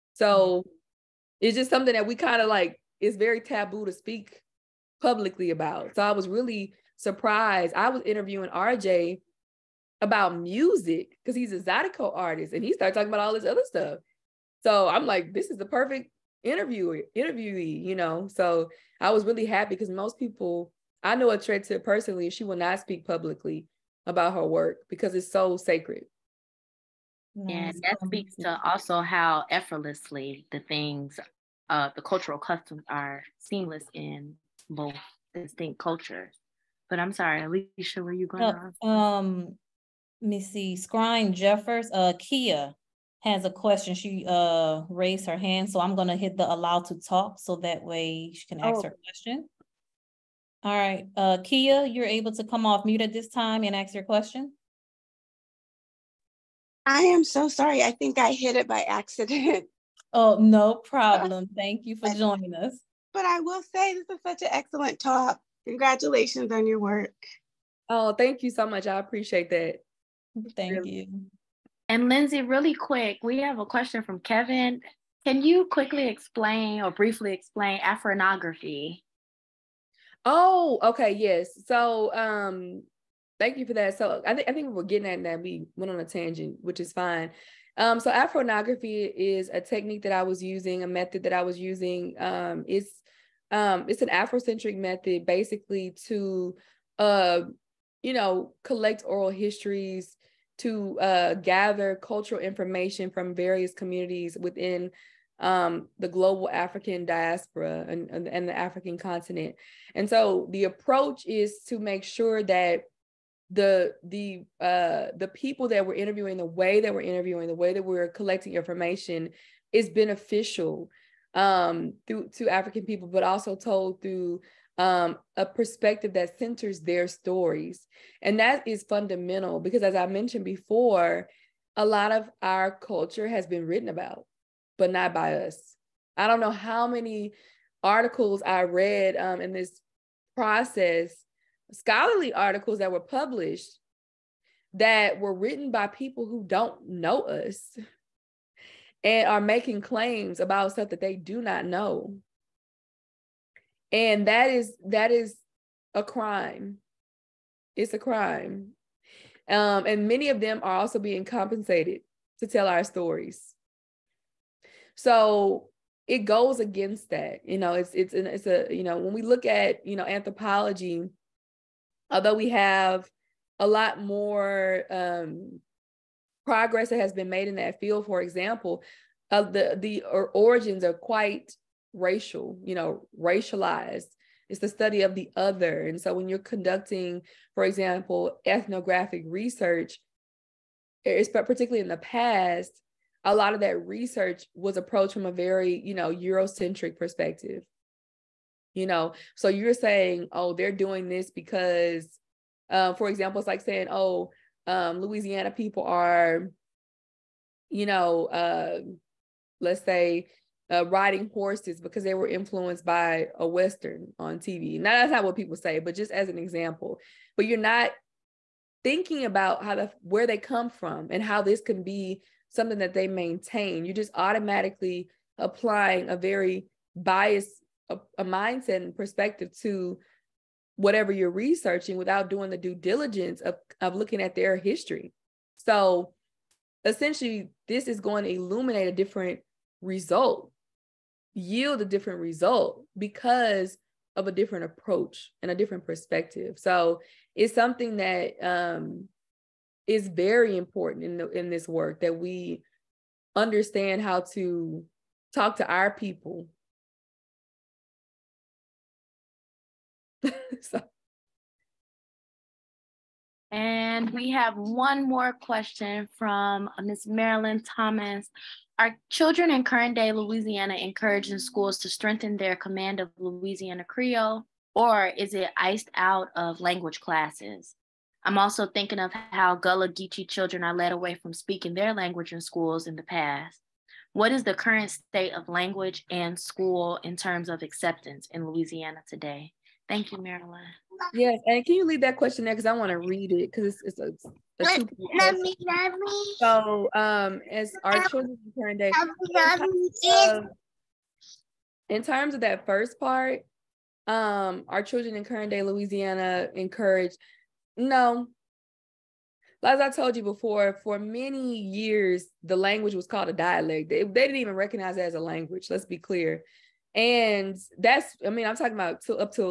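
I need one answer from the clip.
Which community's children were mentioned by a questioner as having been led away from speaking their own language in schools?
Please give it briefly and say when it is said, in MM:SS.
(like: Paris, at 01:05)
Gullah Geechee, at 04:39.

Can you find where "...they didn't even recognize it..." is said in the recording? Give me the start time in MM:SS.
05:14.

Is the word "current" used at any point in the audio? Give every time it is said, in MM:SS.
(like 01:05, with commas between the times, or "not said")
04:29, 04:44, 05:05.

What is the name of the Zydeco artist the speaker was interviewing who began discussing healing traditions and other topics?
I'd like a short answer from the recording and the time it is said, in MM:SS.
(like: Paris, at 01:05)
RJ, at 00:08.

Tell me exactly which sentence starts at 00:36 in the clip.
But I'm sorry, Alicia, where you going?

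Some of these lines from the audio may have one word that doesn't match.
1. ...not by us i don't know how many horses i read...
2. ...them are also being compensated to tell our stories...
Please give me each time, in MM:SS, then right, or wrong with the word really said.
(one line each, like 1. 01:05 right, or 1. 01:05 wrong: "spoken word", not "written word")
1. 02:14 wrong: "articles", not "horses"
2. 02:40 right.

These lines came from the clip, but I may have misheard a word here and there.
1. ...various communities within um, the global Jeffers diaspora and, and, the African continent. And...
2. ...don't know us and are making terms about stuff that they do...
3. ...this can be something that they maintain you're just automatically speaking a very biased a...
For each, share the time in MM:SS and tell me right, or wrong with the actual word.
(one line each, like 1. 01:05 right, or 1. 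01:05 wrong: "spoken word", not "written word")
1. 01:43 wrong: "African", not "Jeffers"
2. 02:26 wrong: "claims", not "terms"
3. 03:41 wrong: "applying", not "speaking".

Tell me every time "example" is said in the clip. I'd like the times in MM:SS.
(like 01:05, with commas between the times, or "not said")
02:58, 03:07, 03:23, 03:36.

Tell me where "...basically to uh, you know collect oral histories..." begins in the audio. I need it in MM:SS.
01:35.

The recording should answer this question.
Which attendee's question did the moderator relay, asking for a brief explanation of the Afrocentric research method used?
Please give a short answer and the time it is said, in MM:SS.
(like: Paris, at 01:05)
Kevin, at 01:14.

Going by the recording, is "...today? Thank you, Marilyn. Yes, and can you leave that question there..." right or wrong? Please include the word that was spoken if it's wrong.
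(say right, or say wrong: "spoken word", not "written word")
right.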